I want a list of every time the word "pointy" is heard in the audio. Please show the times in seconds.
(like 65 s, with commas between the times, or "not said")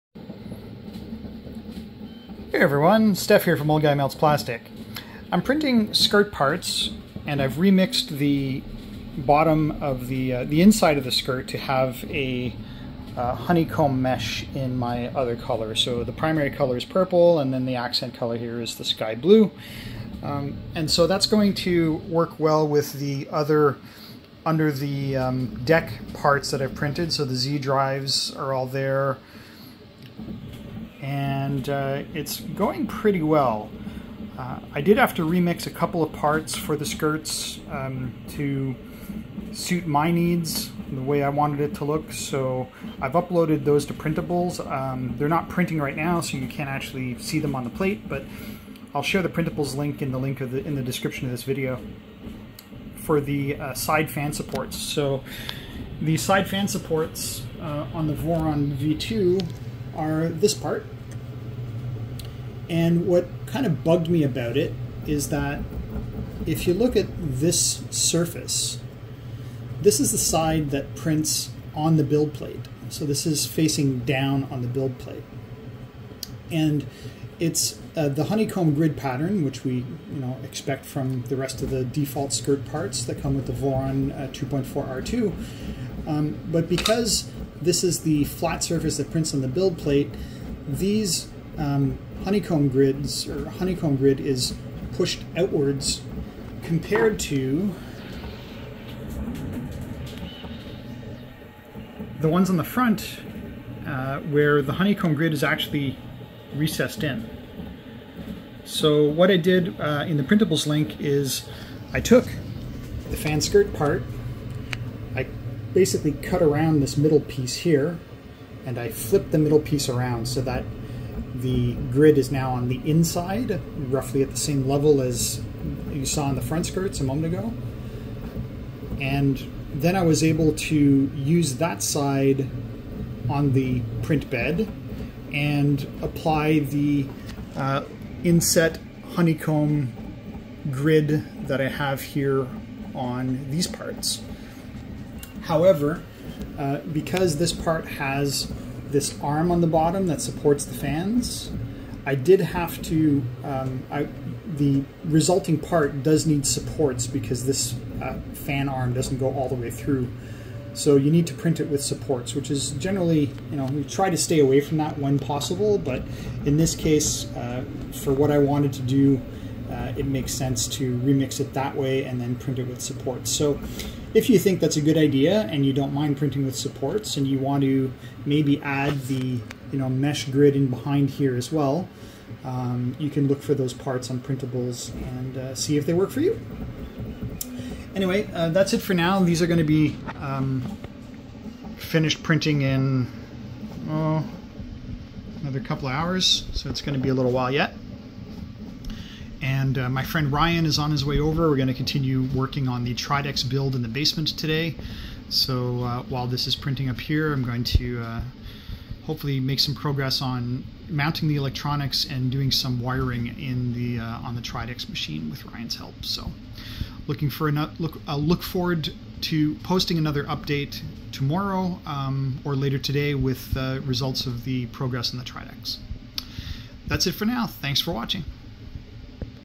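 not said.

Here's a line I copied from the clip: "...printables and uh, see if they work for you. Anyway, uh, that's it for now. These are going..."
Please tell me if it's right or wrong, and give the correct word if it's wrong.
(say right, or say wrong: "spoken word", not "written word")
right.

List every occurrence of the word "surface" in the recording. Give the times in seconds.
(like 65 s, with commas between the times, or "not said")
67 s, 88 s.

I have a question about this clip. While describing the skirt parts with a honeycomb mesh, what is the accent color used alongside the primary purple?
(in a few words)
Sky blue.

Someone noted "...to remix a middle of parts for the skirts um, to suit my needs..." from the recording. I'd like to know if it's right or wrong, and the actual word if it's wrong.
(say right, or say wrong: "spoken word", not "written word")
wrong: "couple", not "middle".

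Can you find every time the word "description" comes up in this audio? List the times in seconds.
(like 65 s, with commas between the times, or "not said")
50 s.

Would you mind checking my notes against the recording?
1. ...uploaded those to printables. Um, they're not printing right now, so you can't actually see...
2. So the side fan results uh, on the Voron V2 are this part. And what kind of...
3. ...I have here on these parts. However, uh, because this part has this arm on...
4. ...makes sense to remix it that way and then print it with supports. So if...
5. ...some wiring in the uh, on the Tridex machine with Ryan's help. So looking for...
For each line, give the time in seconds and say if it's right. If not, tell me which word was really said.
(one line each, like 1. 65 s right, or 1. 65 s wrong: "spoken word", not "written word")
1. 43 s right
2. 54 s wrong: "supports", not "results"
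3. 141 s right
4. 170 s right
5. 212 s right.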